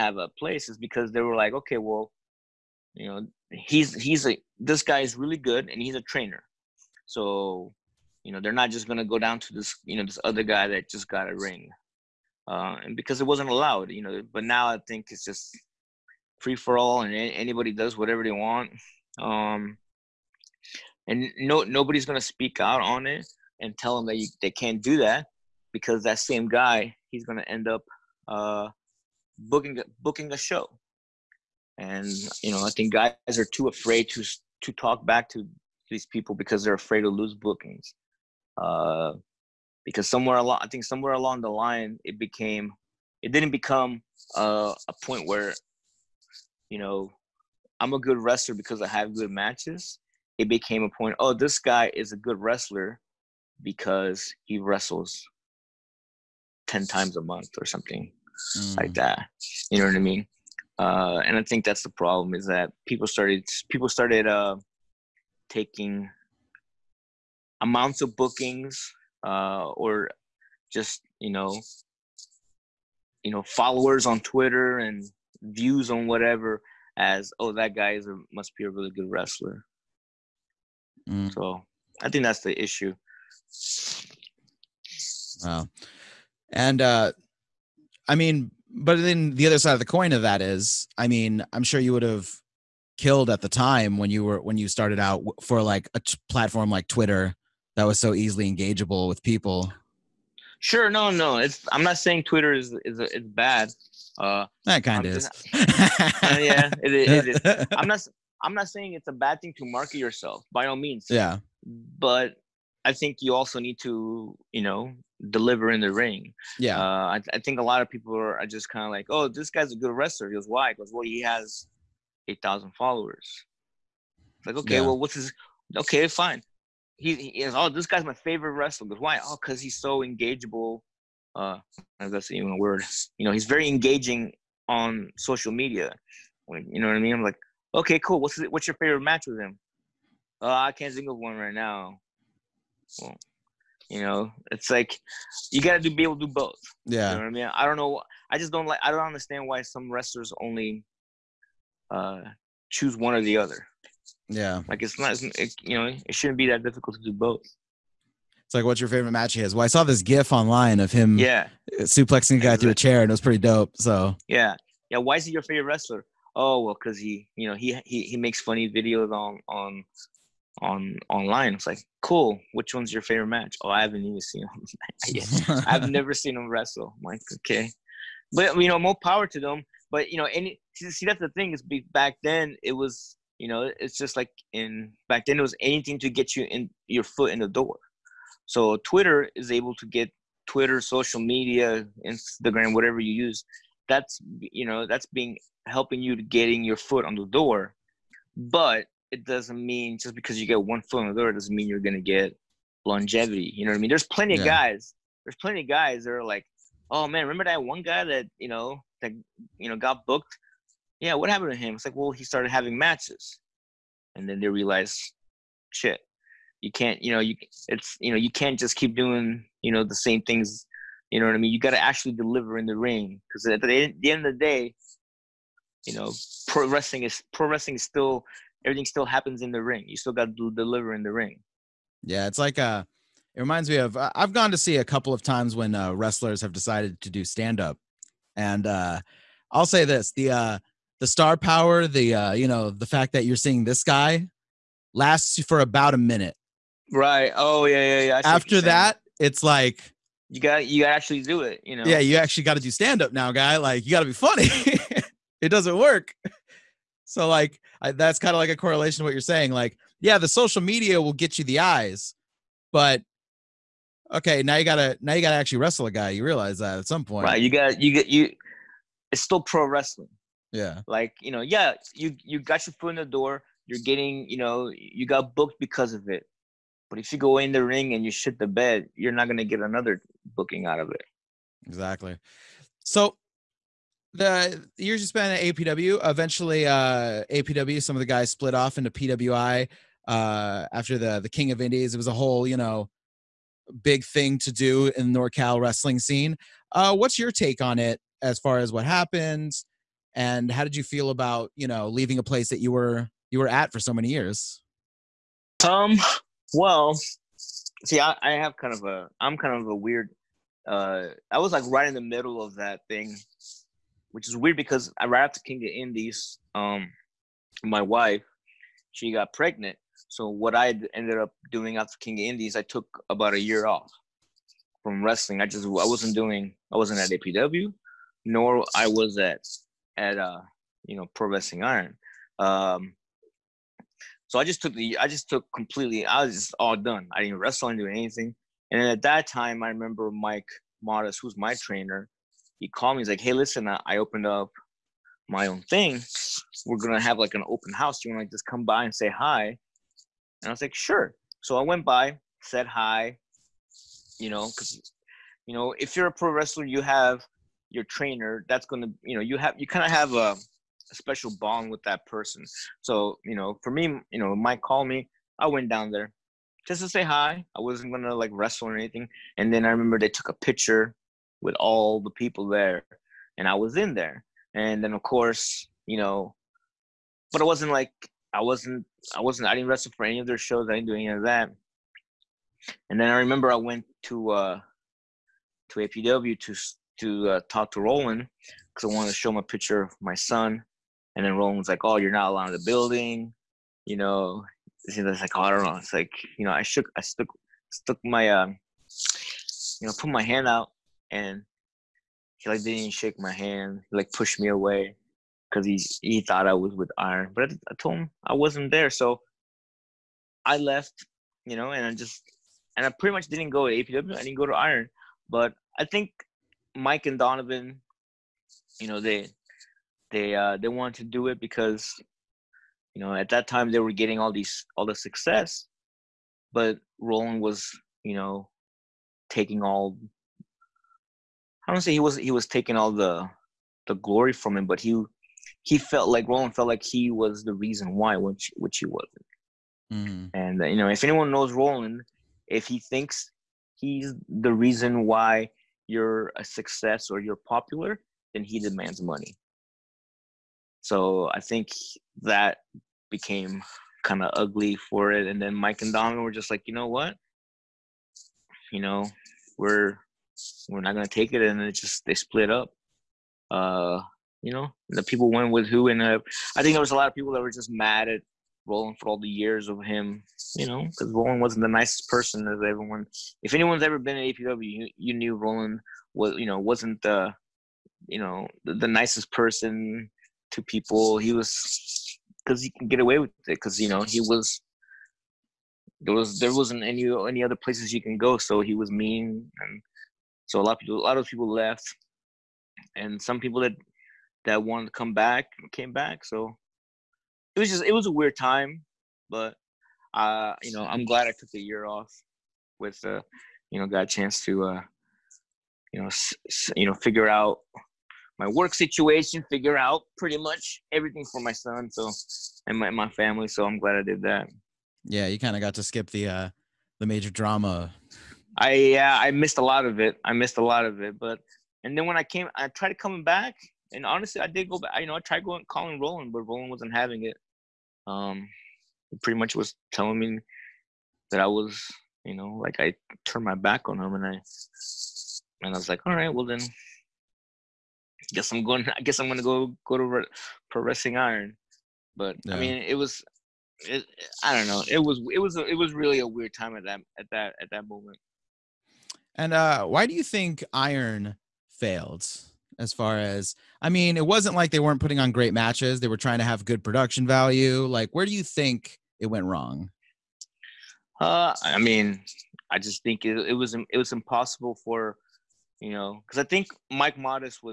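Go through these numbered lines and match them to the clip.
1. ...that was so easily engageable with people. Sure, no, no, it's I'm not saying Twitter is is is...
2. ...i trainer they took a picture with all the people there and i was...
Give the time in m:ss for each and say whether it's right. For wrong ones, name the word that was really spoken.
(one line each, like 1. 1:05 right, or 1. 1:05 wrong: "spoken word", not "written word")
1. 1:37 right
2. 6:09 wrong: "remember", not "trainer".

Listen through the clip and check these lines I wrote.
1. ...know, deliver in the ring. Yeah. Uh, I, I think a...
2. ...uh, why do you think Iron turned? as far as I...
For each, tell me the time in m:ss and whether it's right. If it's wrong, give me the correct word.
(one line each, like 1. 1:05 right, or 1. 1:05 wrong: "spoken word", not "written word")
1. 1:54 right
2. 9:09 wrong: "failed", not "turned".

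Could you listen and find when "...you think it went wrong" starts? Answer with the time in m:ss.
9:18.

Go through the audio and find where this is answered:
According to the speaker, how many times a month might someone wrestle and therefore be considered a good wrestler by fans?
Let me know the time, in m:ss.
0:56.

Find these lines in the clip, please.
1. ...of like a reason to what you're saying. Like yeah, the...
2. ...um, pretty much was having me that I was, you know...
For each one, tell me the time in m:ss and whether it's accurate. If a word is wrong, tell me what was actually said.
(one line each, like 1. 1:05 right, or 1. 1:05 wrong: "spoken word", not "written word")
1. 4:18 wrong: "correlation", not "reason"
2. 8:48 wrong: "telling", not "having".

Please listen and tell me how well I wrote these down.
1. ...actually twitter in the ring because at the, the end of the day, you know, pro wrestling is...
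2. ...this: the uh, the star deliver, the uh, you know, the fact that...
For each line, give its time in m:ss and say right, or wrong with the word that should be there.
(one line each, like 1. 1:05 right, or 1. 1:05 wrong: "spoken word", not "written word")
1. 3:41 wrong: "deliver", not "twitter"
2. 3:59 wrong: "power", not "deliver".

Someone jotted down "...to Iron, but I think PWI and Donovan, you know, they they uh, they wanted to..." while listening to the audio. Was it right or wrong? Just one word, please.
wrong.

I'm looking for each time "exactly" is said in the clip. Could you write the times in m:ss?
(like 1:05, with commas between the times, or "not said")
2:42, 4:41.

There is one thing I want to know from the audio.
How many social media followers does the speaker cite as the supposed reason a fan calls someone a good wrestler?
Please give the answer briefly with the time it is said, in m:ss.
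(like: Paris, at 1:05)
8000, at 2:02.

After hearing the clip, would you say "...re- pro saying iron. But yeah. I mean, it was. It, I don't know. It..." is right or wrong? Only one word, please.
wrong.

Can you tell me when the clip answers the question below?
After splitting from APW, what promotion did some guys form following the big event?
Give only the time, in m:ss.
4:48.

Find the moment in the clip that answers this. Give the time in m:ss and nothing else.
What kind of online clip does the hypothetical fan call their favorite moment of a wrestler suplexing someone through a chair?
2:40.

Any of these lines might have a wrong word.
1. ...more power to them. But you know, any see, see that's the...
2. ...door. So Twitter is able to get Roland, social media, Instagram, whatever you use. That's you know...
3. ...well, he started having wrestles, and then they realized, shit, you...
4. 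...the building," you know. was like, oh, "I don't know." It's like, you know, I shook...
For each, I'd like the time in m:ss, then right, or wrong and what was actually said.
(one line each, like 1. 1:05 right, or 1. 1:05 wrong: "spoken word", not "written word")
1. 2:58 right
2. 3:07 wrong: "Twitter", not "Roland"
3. 3:31 wrong: "matches", not "wrestles"
4. 6:32 right.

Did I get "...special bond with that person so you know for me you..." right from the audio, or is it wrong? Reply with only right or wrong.
right.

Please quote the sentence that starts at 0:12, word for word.
Uh, and because it wasn't allowed, you know.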